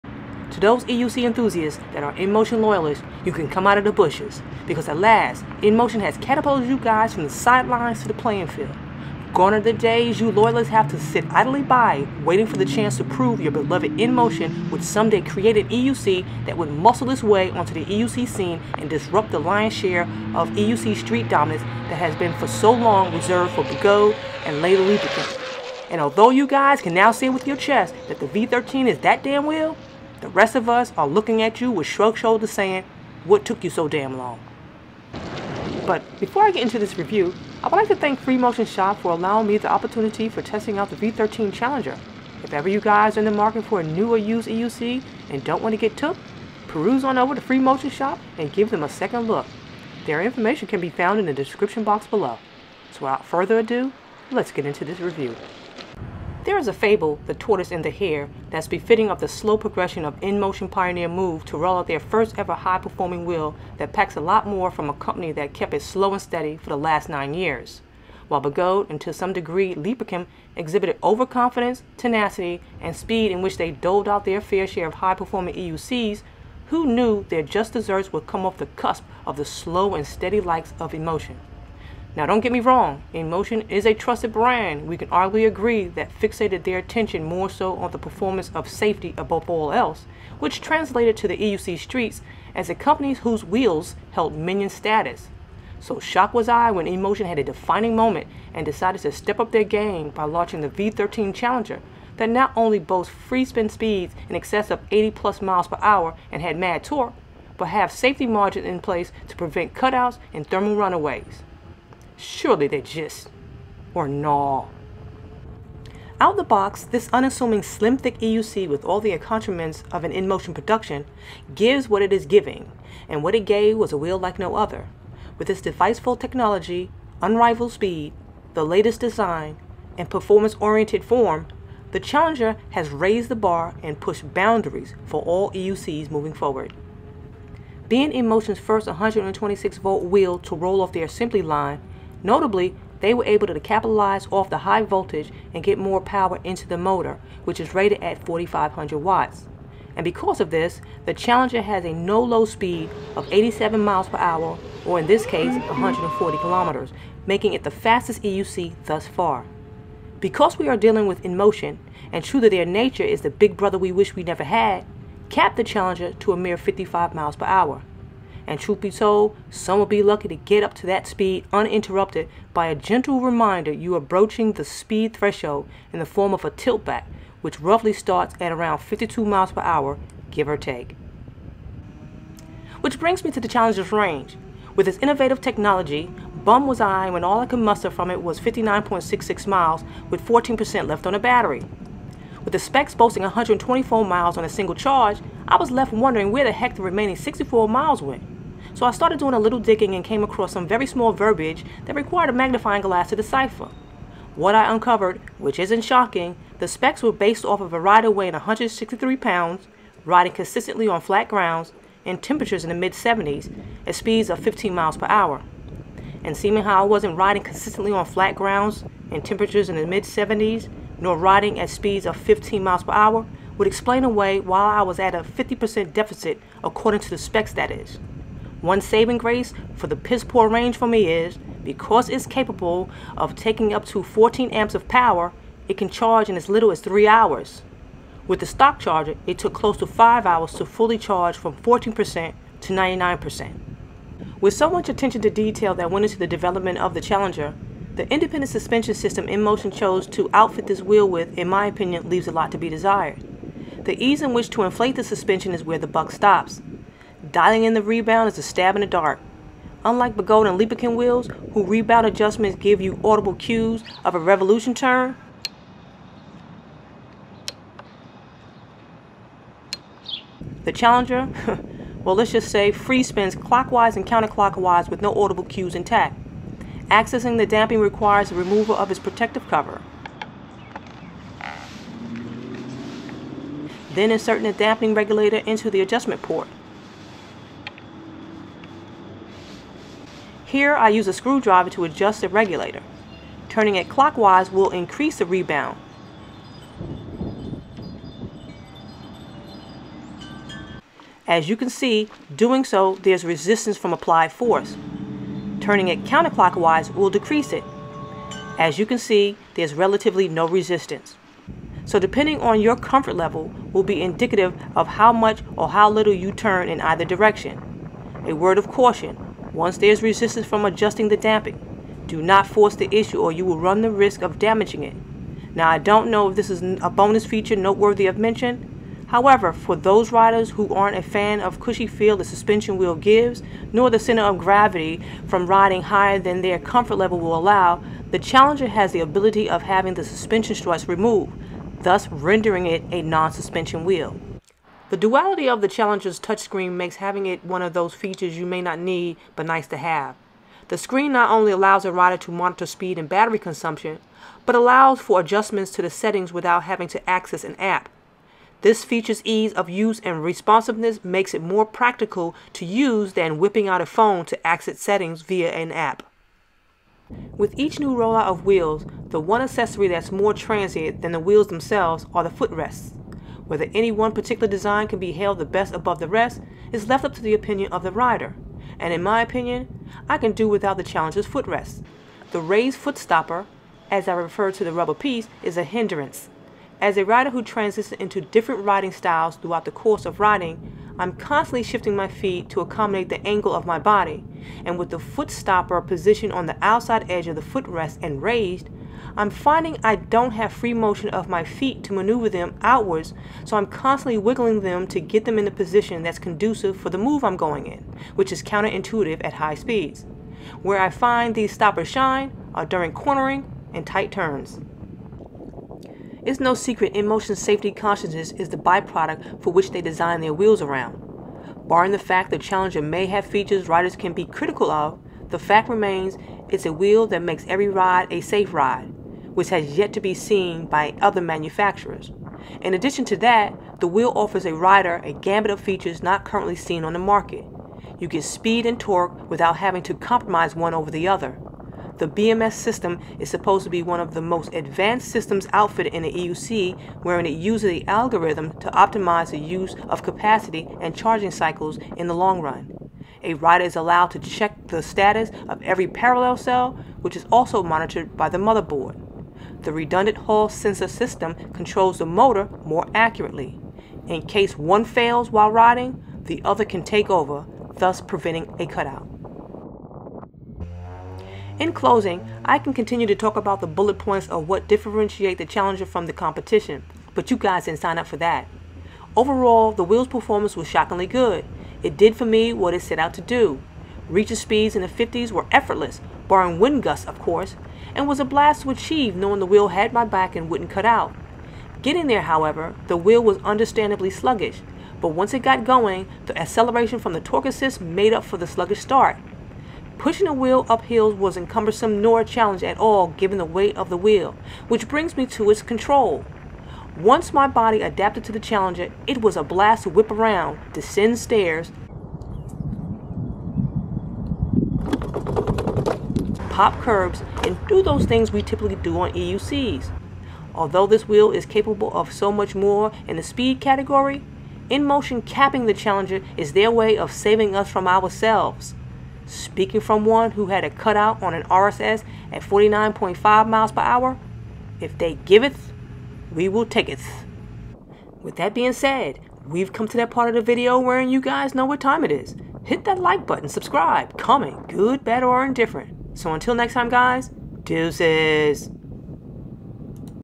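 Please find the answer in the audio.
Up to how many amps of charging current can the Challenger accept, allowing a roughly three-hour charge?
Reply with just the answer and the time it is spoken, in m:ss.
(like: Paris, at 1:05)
14 amps, at 3:54.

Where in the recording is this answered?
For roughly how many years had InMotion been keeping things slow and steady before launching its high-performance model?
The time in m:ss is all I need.
1:07.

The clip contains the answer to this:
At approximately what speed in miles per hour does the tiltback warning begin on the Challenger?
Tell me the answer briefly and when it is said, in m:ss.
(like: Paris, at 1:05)
52 mph, at 2:58.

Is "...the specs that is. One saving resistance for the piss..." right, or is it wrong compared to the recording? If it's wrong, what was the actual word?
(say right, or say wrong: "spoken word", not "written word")
wrong: "grace", not "resistance".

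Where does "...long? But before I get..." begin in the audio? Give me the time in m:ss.
0:34.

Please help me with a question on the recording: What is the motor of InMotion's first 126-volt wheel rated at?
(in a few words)
4500 watts.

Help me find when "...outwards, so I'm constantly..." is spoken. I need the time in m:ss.
6:42.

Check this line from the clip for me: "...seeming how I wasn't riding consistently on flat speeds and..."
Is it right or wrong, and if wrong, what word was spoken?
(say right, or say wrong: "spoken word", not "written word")
wrong: "grounds", not "speeds".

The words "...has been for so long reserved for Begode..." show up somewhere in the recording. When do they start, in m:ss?
0:21.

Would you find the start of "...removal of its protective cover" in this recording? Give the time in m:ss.
4:38.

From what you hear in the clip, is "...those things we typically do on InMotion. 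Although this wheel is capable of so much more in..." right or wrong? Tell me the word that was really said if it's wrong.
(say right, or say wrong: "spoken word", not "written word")
wrong: "EUCs", not "InMotion".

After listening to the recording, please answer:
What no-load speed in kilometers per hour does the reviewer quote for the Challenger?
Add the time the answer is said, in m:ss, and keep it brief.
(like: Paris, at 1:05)
140 kilometers, at 2:35.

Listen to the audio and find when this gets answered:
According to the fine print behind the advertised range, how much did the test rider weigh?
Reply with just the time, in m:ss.
3:28.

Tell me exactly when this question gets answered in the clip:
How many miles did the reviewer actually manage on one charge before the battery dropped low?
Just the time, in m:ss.
3:08.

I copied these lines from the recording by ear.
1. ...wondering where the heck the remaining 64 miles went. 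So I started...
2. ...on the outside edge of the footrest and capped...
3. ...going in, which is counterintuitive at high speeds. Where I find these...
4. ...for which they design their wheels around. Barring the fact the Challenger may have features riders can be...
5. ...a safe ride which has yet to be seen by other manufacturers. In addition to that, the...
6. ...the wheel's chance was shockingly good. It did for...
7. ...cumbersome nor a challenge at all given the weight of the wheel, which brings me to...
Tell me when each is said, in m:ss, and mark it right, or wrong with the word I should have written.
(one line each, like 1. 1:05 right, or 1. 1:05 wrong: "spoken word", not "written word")
1. 3:15 right
2. 6:36 wrong: "raised", not "capped"
3. 6:47 right
4. 6:59 right
5. 7:08 right
6. 7:59 wrong: "performance", not "chance"
7. 8:21 right.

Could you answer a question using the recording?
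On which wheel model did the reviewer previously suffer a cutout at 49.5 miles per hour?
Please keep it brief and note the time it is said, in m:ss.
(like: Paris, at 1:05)
RSS, at 8:51.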